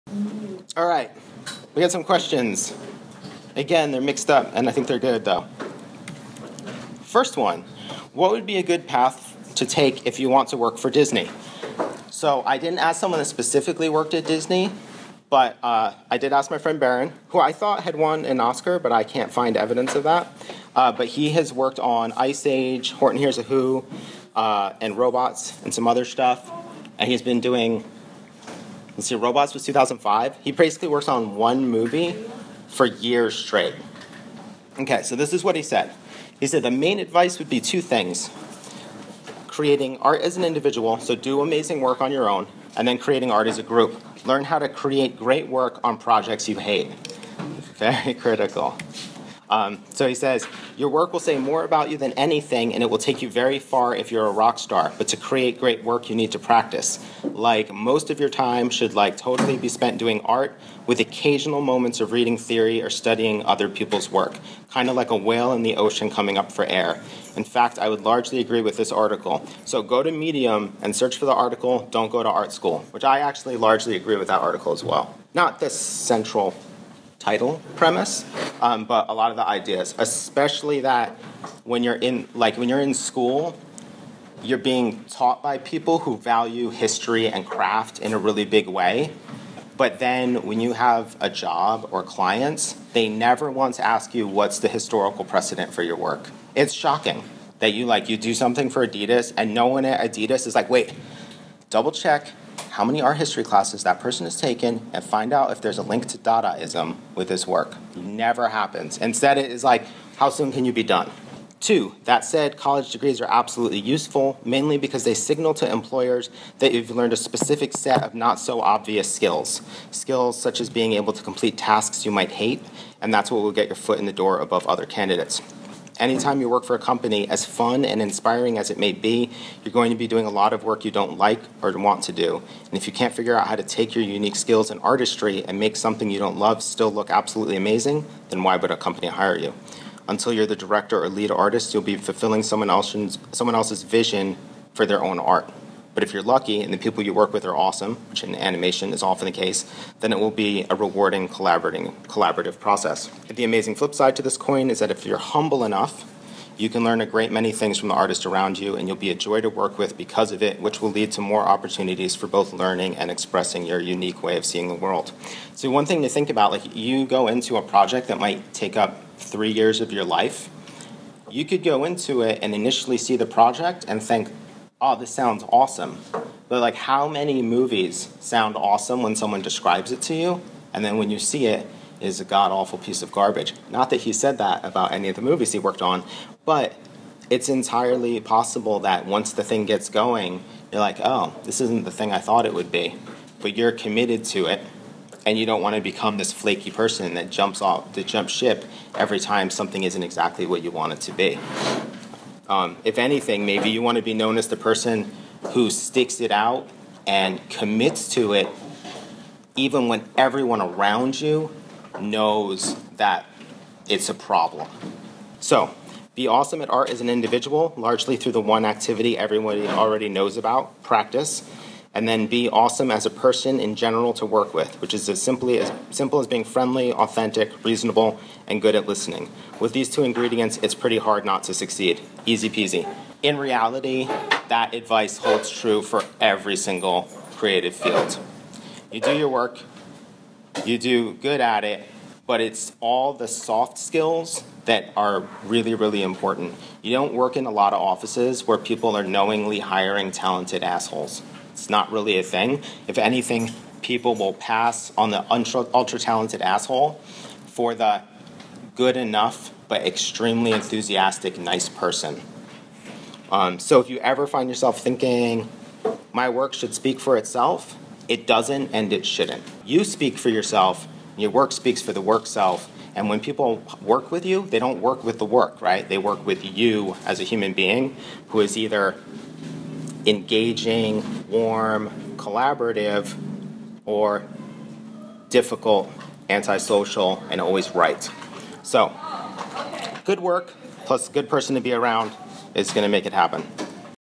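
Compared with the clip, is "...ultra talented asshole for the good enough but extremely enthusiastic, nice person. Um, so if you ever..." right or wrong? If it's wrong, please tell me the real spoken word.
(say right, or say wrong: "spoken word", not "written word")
right.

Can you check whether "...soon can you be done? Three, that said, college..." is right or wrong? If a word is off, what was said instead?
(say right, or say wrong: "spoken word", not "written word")
wrong: "Two", not "Three".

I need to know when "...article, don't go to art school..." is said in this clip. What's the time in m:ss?
1:11.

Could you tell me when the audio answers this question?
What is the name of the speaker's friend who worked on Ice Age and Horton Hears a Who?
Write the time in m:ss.
0:16.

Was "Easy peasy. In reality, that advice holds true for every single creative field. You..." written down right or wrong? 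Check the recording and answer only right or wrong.
right.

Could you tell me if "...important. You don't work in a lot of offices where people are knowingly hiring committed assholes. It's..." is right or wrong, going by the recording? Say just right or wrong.
wrong.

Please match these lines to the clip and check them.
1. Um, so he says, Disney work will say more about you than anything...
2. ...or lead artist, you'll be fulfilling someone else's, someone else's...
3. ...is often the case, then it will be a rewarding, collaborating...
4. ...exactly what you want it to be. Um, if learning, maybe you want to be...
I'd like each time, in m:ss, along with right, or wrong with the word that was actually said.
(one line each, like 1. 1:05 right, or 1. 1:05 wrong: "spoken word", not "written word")
1. 0:49 wrong: "Your", not "Disney"
2. 2:21 right
3. 2:28 right
4. 3:20 wrong: "anything", not "learning".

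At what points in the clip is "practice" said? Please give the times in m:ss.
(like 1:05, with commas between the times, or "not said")
0:56, 3:40.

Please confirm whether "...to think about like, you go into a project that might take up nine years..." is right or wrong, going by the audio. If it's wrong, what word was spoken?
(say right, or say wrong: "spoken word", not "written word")
wrong: "three", not "nine".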